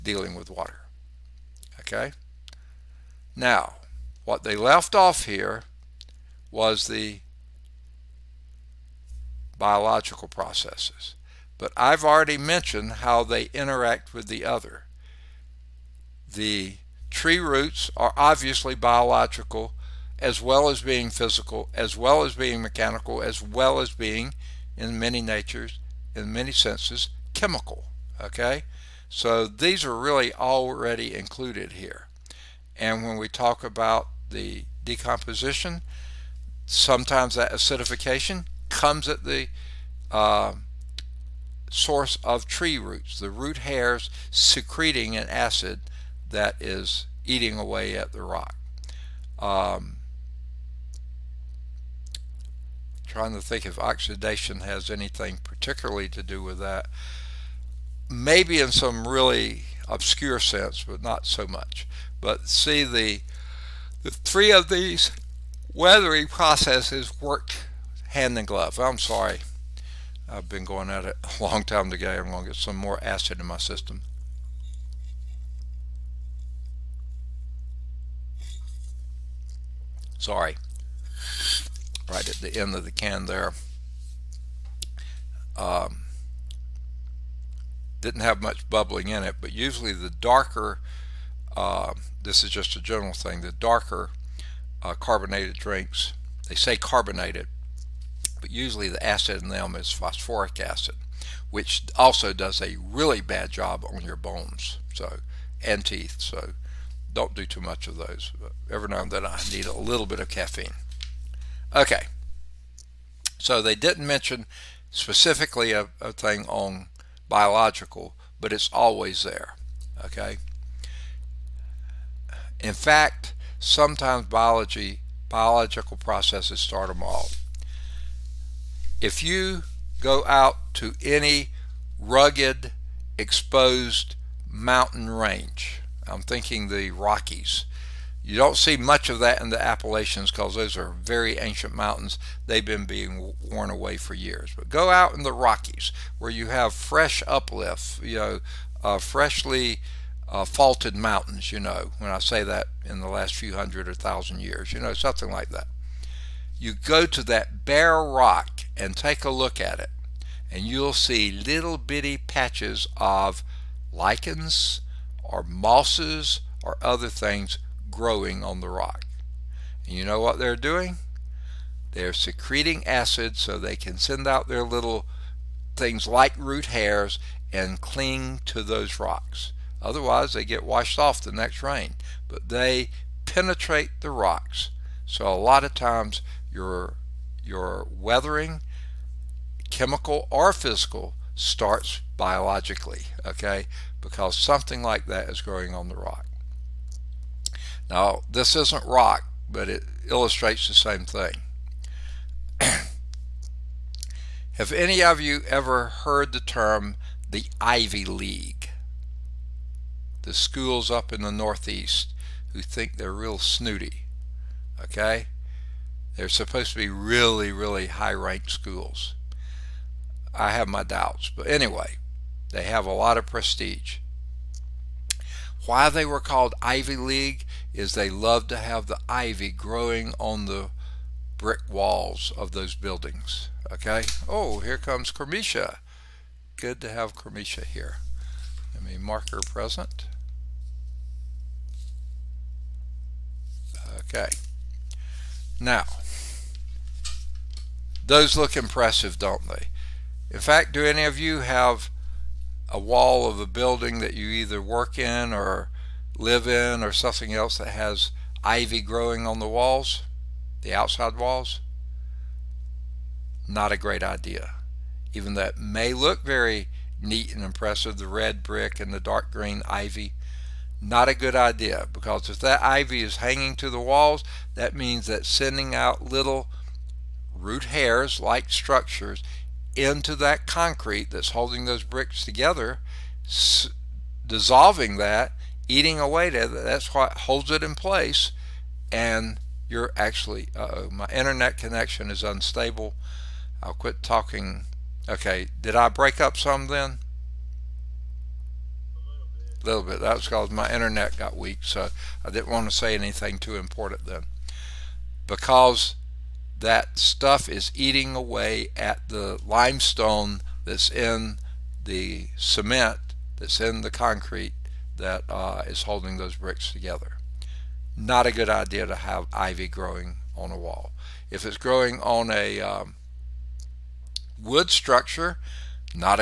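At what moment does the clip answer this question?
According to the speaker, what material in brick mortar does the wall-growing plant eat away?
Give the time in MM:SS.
05:09.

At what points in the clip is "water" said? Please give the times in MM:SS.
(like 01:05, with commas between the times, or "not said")
00:00.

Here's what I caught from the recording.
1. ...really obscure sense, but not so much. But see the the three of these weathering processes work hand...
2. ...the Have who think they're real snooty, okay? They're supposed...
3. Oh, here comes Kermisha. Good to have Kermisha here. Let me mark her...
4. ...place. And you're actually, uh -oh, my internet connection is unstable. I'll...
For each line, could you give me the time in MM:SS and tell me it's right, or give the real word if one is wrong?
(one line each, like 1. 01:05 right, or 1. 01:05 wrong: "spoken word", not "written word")
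1. 00:59 right
2. 03:31 wrong: "Northeast", not "Have"
3. 03:54 right
4. 04:47 right.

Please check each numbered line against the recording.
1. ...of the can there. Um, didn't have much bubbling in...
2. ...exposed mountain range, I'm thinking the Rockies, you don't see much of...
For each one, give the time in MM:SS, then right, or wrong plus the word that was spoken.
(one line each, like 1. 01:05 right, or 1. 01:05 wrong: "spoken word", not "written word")
1. 01:22 right
2. 02:13 right.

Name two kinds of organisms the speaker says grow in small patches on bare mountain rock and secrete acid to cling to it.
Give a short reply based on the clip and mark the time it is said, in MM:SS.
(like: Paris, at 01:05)
lichens or mosses, at 02:43.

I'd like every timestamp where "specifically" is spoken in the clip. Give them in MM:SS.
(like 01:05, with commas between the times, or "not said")
01:54.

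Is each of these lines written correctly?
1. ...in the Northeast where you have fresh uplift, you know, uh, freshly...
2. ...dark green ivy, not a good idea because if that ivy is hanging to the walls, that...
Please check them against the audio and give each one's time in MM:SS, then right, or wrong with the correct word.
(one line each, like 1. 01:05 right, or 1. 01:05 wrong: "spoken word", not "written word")
1. 02:25 wrong: "Rockies", not "Northeast"
2. 04:29 right.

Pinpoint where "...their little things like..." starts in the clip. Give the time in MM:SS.
02:54.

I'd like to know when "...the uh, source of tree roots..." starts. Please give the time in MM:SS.
00:39.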